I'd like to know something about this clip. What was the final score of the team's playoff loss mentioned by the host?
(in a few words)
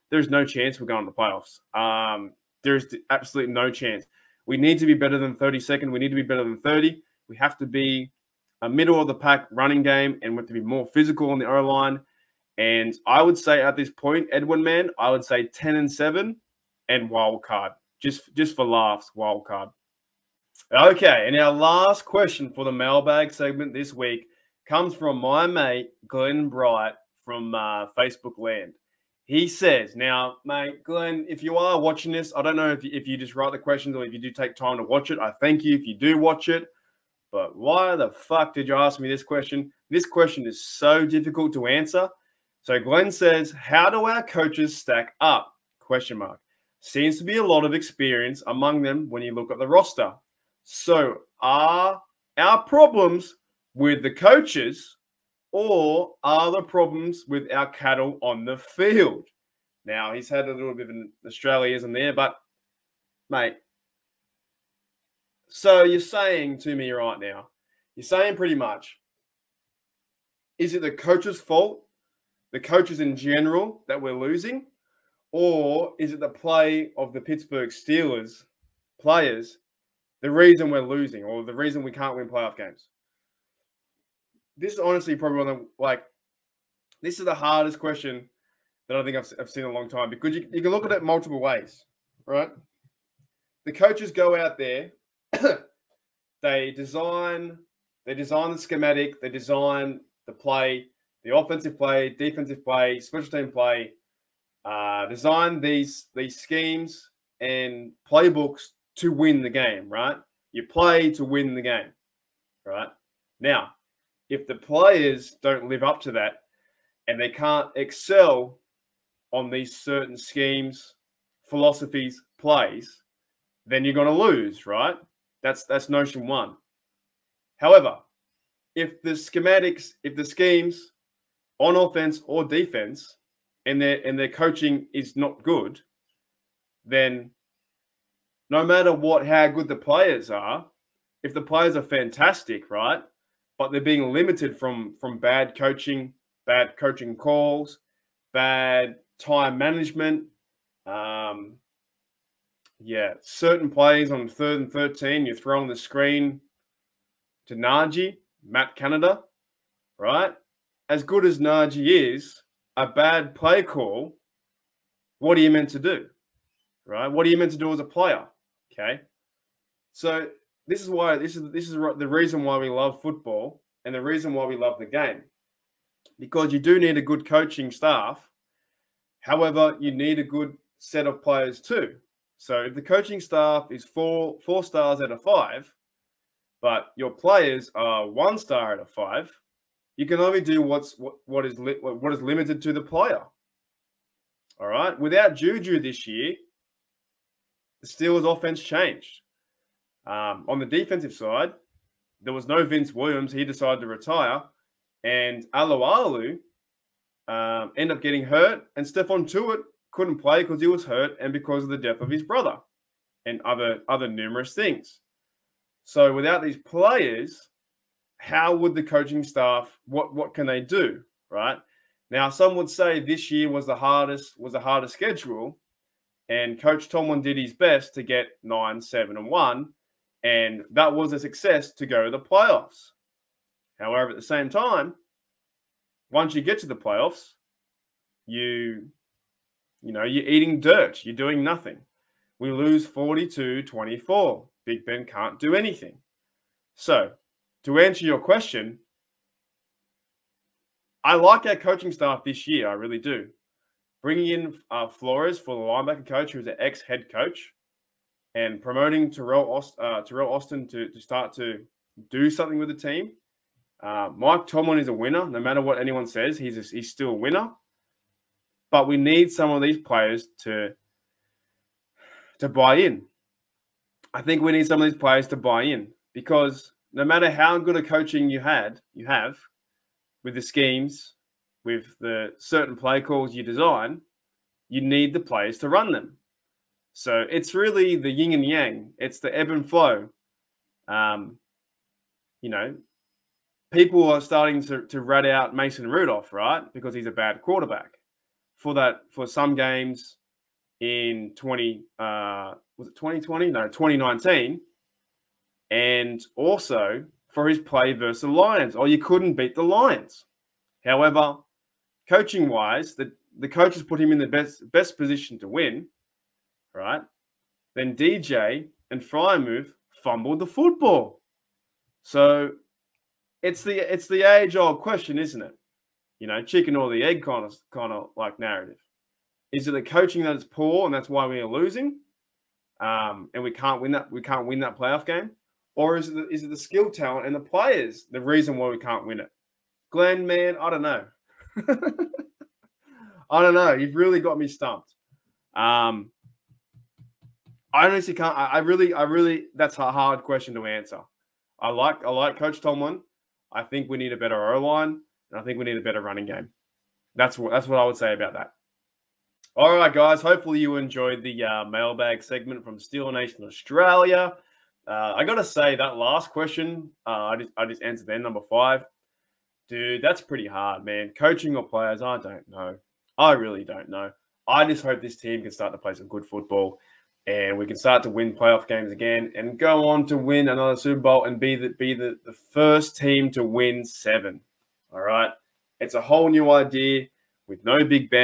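42-24.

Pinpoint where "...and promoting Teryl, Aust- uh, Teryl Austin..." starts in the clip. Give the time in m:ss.
4:18.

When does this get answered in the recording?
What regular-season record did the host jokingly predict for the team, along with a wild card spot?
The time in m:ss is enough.
0:15.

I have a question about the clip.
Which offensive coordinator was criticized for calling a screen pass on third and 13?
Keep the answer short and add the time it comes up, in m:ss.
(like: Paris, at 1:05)
Matt Canada, at 2:38.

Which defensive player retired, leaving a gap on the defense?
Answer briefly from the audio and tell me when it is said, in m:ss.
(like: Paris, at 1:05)
Vince Williams, at 3:22.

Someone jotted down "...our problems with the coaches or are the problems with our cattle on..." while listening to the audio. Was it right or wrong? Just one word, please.
right.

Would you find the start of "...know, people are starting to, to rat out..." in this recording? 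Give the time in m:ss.
4:52.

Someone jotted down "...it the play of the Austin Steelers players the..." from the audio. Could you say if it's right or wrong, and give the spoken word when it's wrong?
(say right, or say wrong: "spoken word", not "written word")
wrong: "Pittsburgh", not "Austin".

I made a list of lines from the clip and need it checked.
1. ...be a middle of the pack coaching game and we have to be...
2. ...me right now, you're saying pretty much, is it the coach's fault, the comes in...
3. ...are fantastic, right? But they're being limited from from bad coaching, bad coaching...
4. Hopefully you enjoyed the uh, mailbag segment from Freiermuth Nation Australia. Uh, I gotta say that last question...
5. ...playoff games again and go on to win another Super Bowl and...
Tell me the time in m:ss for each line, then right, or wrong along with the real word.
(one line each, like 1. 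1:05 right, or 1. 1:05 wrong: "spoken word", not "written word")
1. 0:07 wrong: "running", not "coaching"
2. 1:06 wrong: "coaches", not "comes"
3. 2:21 right
4. 6:00 wrong: "Steel", not "Freiermuth"
5. 6:18 right.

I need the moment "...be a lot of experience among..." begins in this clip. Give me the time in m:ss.
0:47.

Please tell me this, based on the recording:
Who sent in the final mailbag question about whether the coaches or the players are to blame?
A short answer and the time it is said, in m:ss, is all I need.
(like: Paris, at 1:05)
Glenn Bright, at 0:26.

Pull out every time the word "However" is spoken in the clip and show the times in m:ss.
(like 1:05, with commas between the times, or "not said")
2:07, 2:59, 3:53, 5:10.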